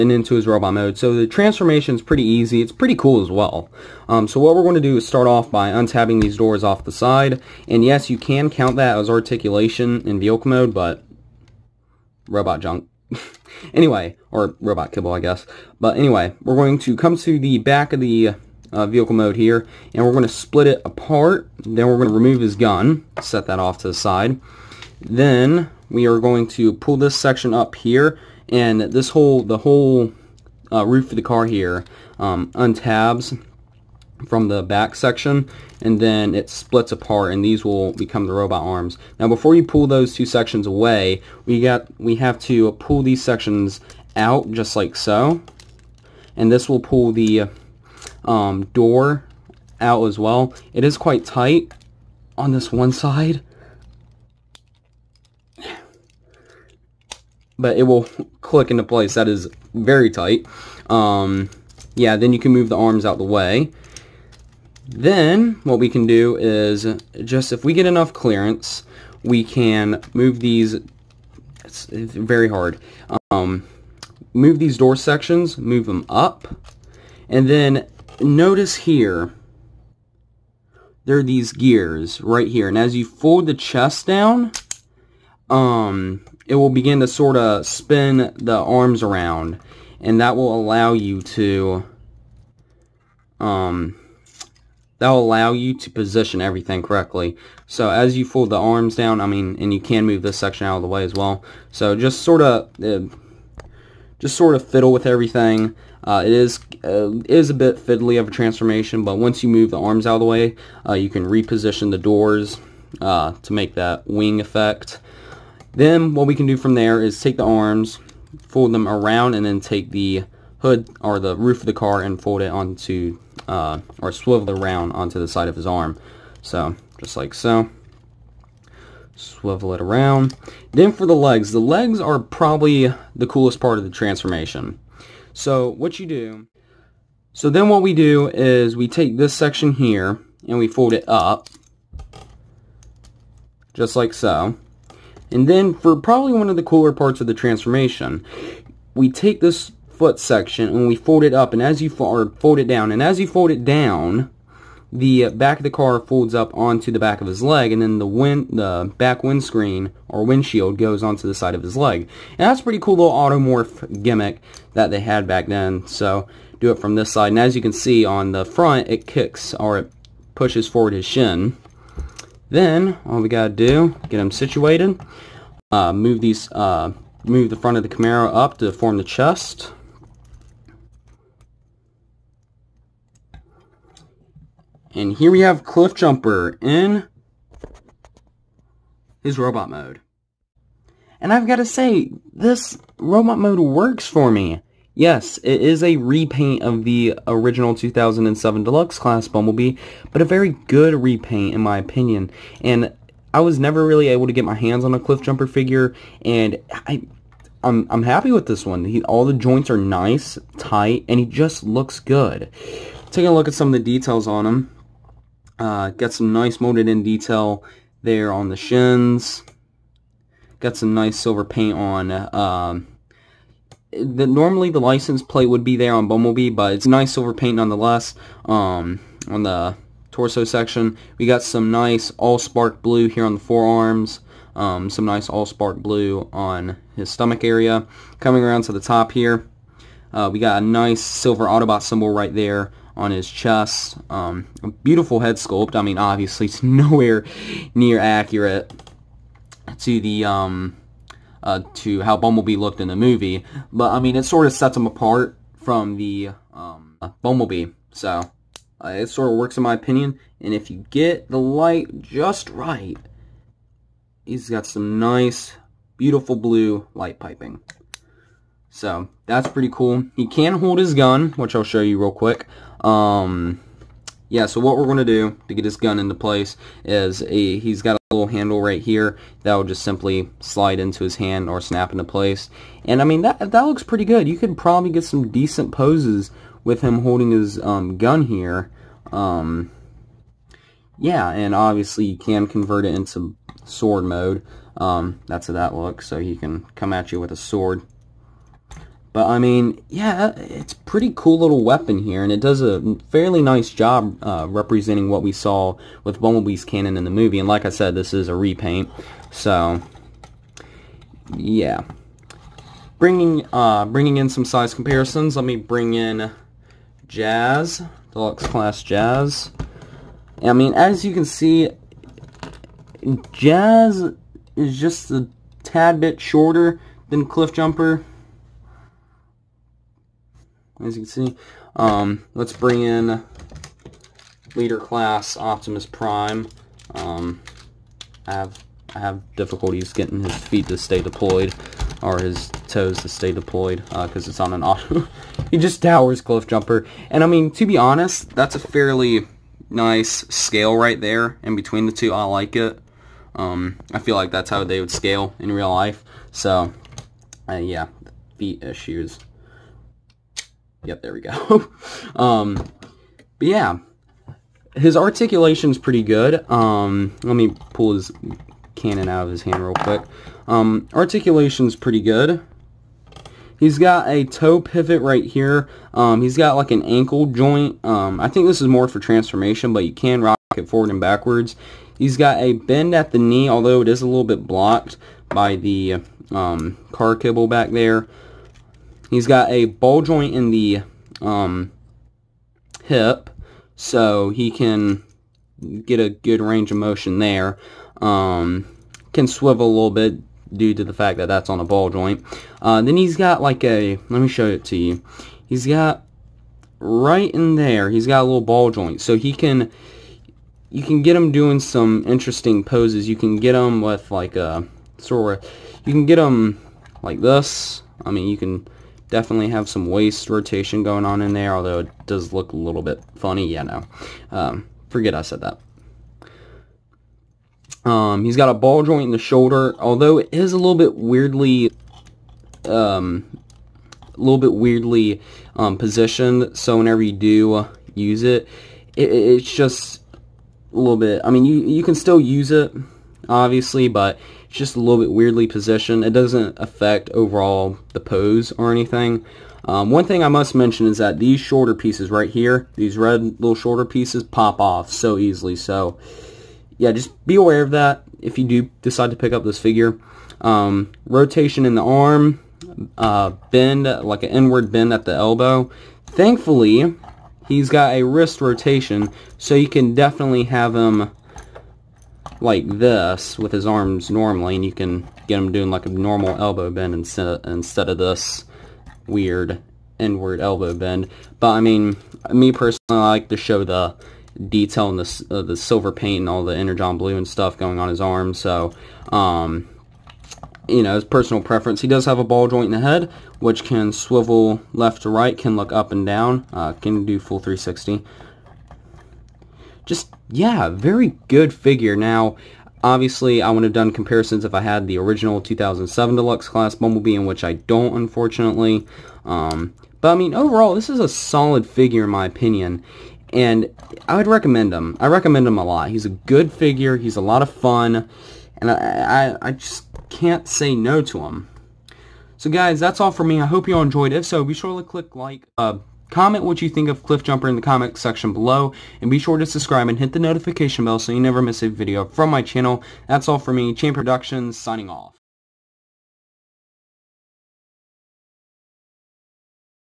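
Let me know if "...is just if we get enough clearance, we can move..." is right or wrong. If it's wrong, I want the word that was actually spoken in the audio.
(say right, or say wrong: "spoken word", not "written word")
right.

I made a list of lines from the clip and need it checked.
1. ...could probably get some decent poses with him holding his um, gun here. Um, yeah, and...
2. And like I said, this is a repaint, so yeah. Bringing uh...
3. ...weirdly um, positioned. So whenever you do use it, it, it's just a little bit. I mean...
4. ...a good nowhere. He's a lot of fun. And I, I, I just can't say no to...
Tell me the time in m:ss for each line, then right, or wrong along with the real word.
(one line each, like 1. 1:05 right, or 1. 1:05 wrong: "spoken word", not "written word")
1. 4:44 right
2. 5:07 right
3. 7:14 right
4. 8:36 wrong: "figure", not "nowhere".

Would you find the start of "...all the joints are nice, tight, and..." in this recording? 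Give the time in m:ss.
3:29.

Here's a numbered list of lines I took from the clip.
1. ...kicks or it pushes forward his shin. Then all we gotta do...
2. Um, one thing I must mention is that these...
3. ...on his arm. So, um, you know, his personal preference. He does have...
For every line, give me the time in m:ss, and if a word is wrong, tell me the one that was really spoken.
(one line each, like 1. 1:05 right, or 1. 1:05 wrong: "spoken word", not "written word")
1. 2:49 right
2. 7:29 right
3. 8:07 right.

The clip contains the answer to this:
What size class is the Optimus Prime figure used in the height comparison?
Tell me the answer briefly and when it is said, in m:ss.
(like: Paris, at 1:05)
leader class, at 5:34.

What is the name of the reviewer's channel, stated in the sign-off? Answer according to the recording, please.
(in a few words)
Champion Productions.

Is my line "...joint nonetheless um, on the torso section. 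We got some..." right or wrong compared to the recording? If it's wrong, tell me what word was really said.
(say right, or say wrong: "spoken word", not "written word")
wrong: "paint", not "joint".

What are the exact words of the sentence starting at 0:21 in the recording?
Then we're going to remove his gun, set that off to the side.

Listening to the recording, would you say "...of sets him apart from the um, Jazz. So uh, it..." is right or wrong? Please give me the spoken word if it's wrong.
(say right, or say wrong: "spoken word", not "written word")
wrong: "Bumblebee", not "Jazz".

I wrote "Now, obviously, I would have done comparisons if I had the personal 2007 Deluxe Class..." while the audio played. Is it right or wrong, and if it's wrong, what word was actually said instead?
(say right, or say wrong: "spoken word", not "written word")
wrong: "original", not "personal".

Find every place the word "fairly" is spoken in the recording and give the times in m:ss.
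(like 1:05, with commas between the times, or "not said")
5:03, 5:48.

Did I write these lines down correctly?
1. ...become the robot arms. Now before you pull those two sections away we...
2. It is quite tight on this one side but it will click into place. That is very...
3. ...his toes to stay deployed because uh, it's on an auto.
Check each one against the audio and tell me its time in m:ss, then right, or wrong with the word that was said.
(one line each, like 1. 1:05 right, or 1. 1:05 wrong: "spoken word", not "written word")
1. 0:37 right
2. 0:50 right
3. 5:42 right.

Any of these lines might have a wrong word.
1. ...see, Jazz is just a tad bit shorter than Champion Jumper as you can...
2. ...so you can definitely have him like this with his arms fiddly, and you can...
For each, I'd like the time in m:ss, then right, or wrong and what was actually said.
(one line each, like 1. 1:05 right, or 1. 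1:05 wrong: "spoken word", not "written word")
1. 5:21 wrong: "Cliff", not "Champion"
2. 7:49 wrong: "normally", not "fiddly".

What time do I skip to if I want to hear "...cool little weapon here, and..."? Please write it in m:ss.
5:01.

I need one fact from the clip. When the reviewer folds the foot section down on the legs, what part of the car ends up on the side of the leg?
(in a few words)
back windscreen.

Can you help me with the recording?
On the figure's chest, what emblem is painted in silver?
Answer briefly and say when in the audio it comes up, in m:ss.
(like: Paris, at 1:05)
Autobot symbol, at 4:01.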